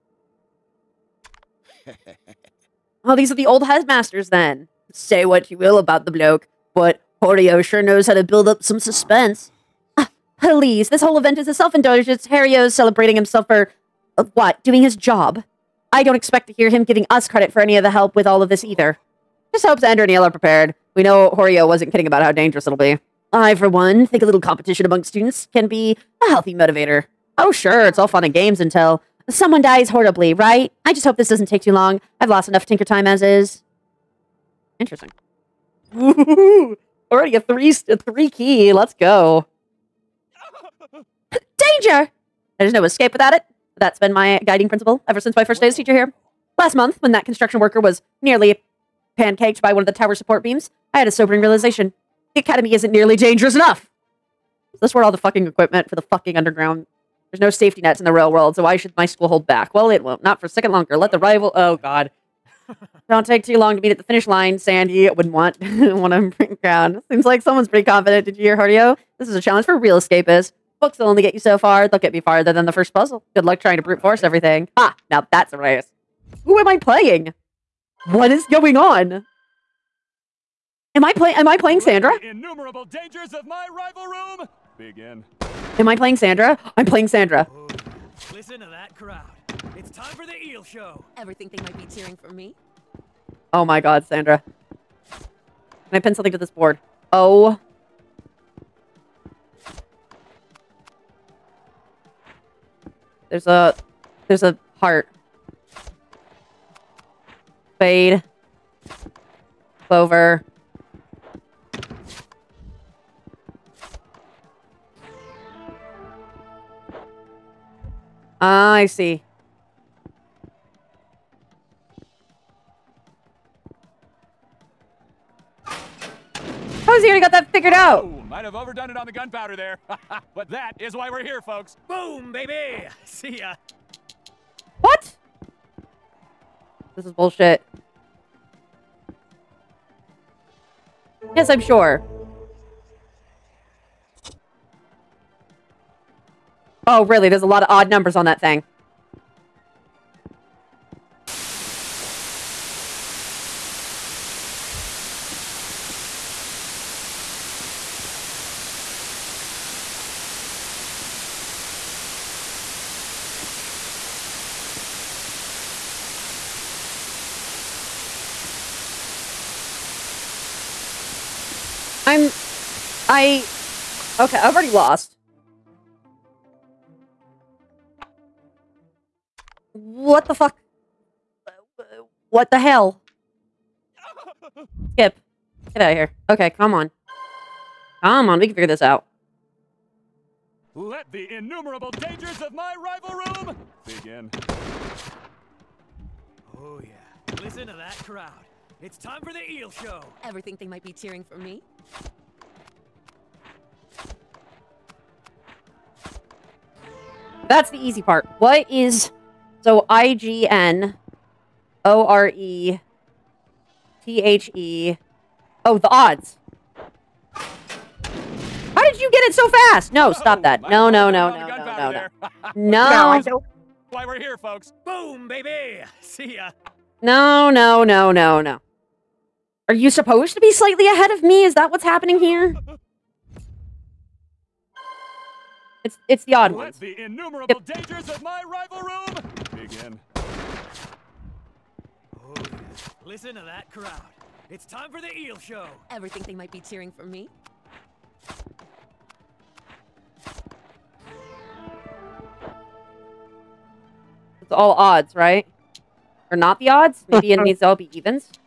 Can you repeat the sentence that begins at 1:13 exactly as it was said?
Good luck trying to brute force everything.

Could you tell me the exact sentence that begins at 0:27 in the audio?
Oh, sure, it's all fun and games until someone dies horribly, right?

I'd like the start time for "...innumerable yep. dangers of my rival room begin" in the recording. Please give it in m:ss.
3:57.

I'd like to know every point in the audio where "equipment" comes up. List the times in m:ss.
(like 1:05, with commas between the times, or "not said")
0:55.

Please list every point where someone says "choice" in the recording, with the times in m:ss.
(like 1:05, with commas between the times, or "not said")
not said.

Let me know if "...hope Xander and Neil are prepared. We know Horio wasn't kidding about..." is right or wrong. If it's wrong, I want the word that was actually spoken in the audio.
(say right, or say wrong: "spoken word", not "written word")
right.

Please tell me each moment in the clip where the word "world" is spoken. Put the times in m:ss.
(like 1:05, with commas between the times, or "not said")
0:58.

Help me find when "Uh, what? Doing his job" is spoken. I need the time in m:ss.
0:14.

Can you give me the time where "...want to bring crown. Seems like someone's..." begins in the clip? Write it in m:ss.
1:05.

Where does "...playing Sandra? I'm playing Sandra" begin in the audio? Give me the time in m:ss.
1:25.